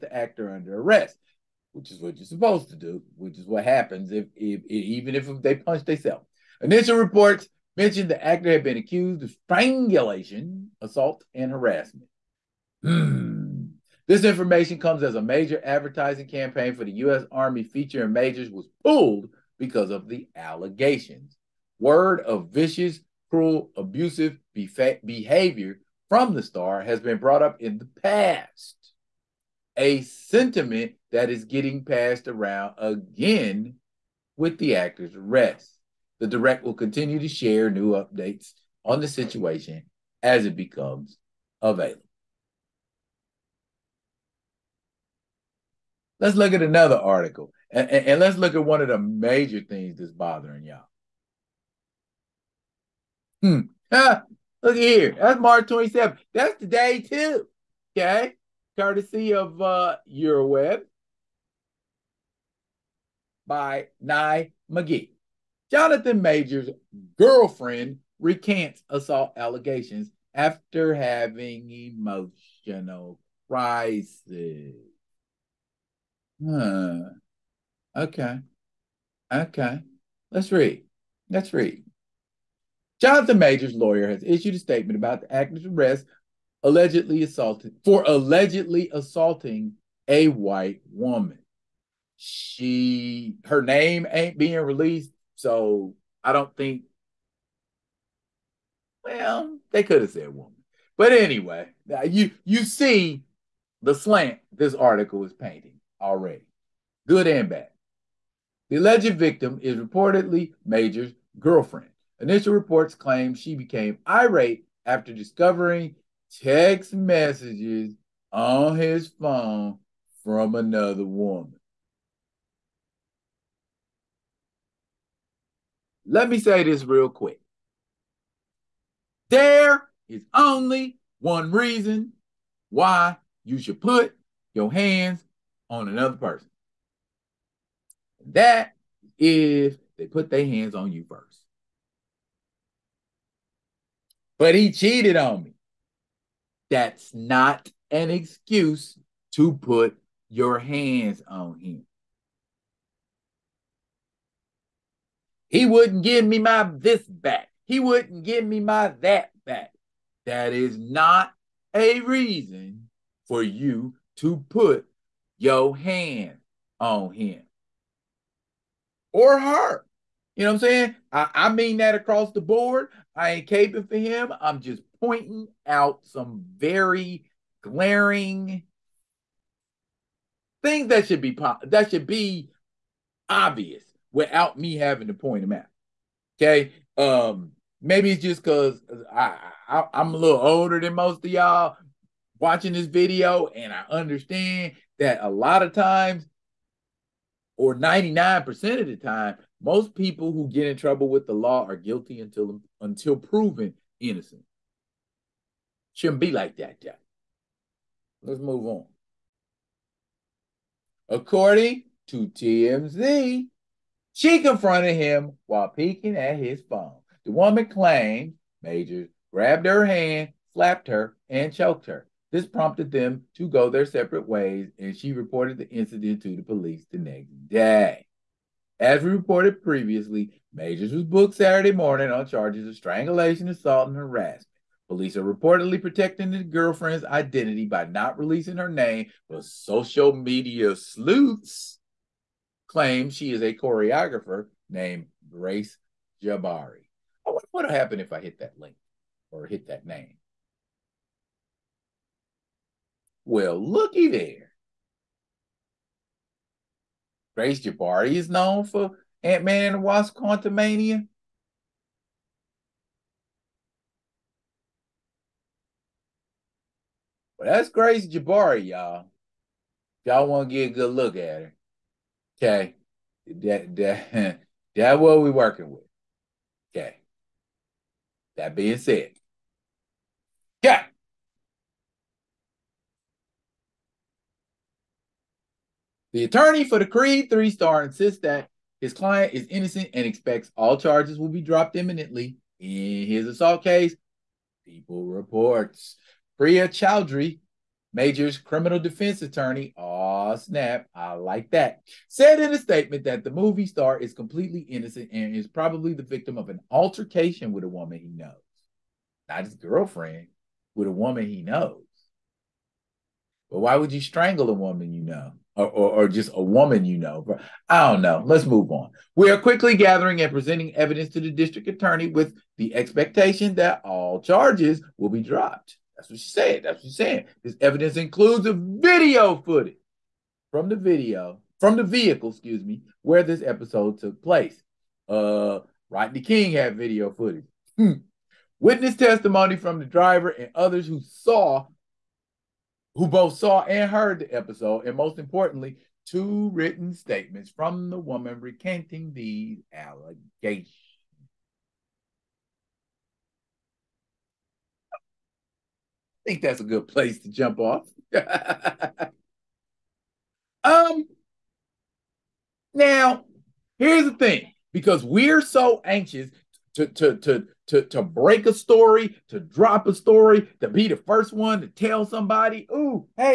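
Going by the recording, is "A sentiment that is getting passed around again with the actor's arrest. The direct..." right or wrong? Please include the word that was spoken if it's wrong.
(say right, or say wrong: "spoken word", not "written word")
right.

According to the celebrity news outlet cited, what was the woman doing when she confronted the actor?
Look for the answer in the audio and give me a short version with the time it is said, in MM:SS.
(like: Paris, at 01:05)
Peeking at his phone, at 03:35.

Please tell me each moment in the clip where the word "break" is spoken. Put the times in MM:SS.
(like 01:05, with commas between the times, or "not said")
06:08.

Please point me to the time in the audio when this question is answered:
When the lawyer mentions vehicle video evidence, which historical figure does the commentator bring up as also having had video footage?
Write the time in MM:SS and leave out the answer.
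05:35.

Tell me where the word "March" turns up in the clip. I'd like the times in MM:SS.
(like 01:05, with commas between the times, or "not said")
00:55.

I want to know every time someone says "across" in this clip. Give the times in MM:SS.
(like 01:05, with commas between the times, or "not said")
02:51.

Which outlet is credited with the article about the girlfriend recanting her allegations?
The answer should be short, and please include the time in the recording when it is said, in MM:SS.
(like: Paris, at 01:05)
Euroweb, at 01:00.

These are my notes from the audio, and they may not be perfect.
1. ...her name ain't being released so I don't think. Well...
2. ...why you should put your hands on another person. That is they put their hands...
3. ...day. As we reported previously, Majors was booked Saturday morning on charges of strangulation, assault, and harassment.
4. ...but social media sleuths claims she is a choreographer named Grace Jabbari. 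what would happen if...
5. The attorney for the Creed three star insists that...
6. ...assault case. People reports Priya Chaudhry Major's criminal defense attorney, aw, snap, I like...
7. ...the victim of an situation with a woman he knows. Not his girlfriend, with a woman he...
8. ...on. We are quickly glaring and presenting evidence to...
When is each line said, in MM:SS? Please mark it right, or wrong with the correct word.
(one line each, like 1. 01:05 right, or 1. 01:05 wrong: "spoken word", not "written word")
1. 01:33 right
2. 02:12 right
3. 03:47 right
4. 03:59 right
5. 04:46 right
6. 04:53 right
7. 05:05 wrong: "altercation", not "situation"
8. 05:18 wrong: "gathering", not "glaring".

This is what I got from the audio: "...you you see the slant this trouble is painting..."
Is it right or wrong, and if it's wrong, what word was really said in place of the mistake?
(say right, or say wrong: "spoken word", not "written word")
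wrong: "article", not "trouble".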